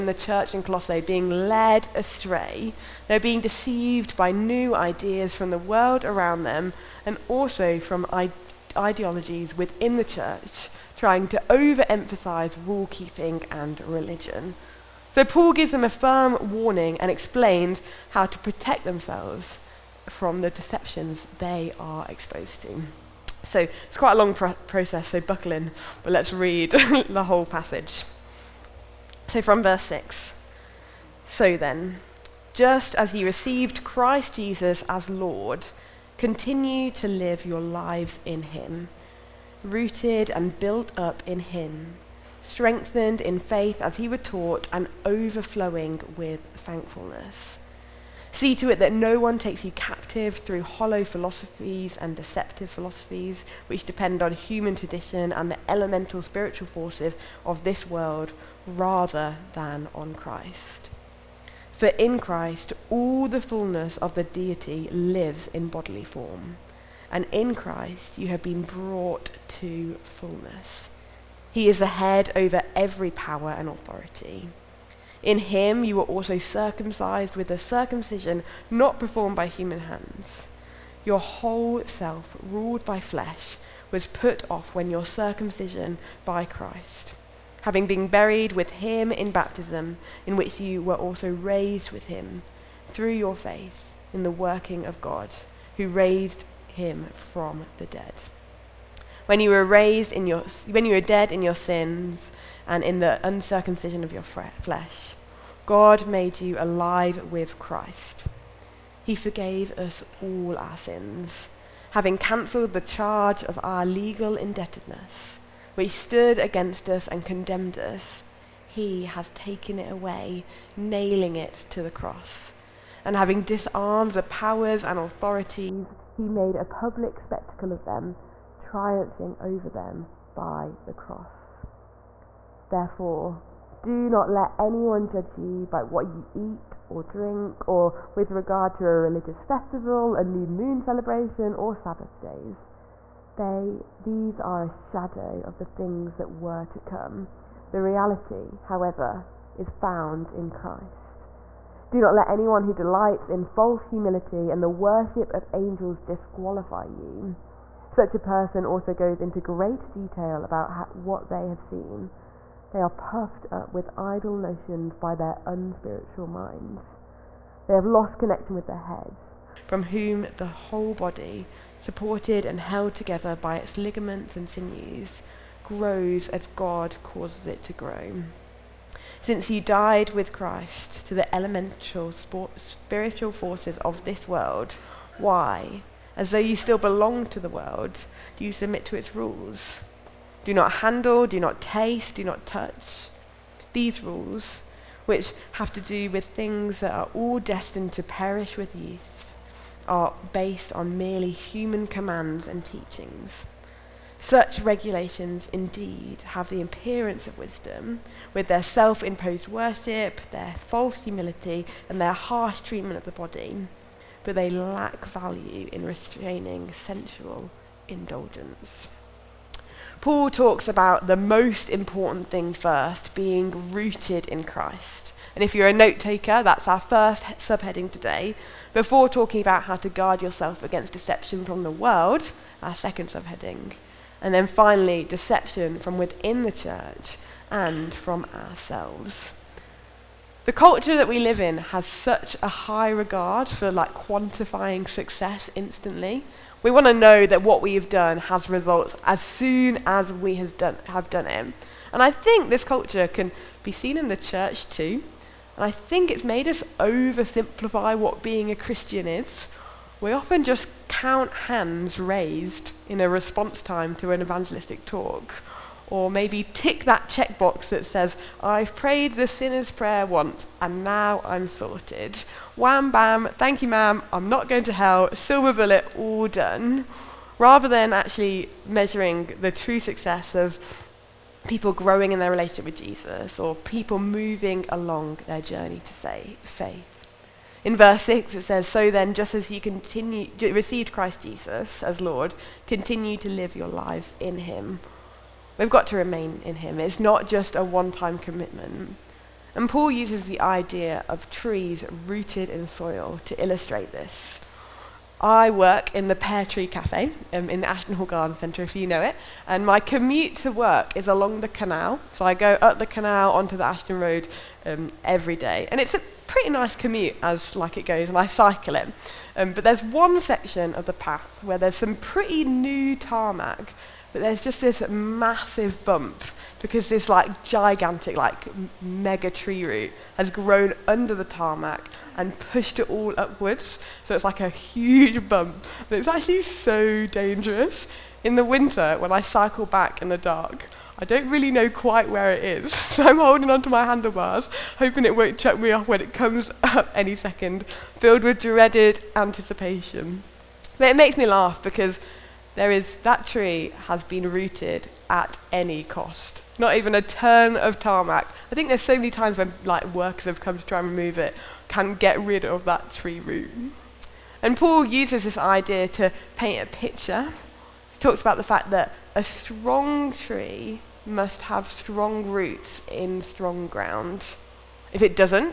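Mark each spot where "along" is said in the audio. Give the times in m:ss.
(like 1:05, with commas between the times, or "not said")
4:44, 5:11.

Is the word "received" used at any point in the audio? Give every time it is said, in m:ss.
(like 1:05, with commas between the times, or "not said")
0:33, 4:50.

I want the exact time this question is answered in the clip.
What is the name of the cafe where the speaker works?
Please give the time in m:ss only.
5:06.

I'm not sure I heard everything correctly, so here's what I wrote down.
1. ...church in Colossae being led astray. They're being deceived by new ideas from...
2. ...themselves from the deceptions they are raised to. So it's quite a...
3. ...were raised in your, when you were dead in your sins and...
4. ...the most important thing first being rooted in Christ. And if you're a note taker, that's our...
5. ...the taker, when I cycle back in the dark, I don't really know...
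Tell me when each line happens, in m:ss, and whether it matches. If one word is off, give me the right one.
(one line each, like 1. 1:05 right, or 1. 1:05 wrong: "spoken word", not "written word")
1. 0:00 right
2. 0:18 wrong: "exposed", not "raised"
3. 1:39 right
4. 3:41 right
5. 5:38 wrong: "winter", not "taker".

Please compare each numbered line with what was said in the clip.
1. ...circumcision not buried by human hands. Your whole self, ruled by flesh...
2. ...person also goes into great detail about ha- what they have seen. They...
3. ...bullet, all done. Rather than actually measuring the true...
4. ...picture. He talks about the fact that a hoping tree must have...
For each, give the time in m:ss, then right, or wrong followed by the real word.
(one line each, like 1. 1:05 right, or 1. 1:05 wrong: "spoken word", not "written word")
1. 1:17 wrong: "performed", not "buried"
2. 2:38 right
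3. 4:35 right
4. 6:06 wrong: "strong", not "hoping".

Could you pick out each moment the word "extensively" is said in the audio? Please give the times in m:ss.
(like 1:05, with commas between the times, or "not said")
not said.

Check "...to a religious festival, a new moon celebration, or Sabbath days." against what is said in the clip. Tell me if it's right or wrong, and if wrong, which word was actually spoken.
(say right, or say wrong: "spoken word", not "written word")
right.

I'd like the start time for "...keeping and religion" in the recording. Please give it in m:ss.
0:12.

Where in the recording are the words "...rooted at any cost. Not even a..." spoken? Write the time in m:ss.
5:54.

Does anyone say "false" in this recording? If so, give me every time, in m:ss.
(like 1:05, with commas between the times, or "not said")
2:33, 3:30.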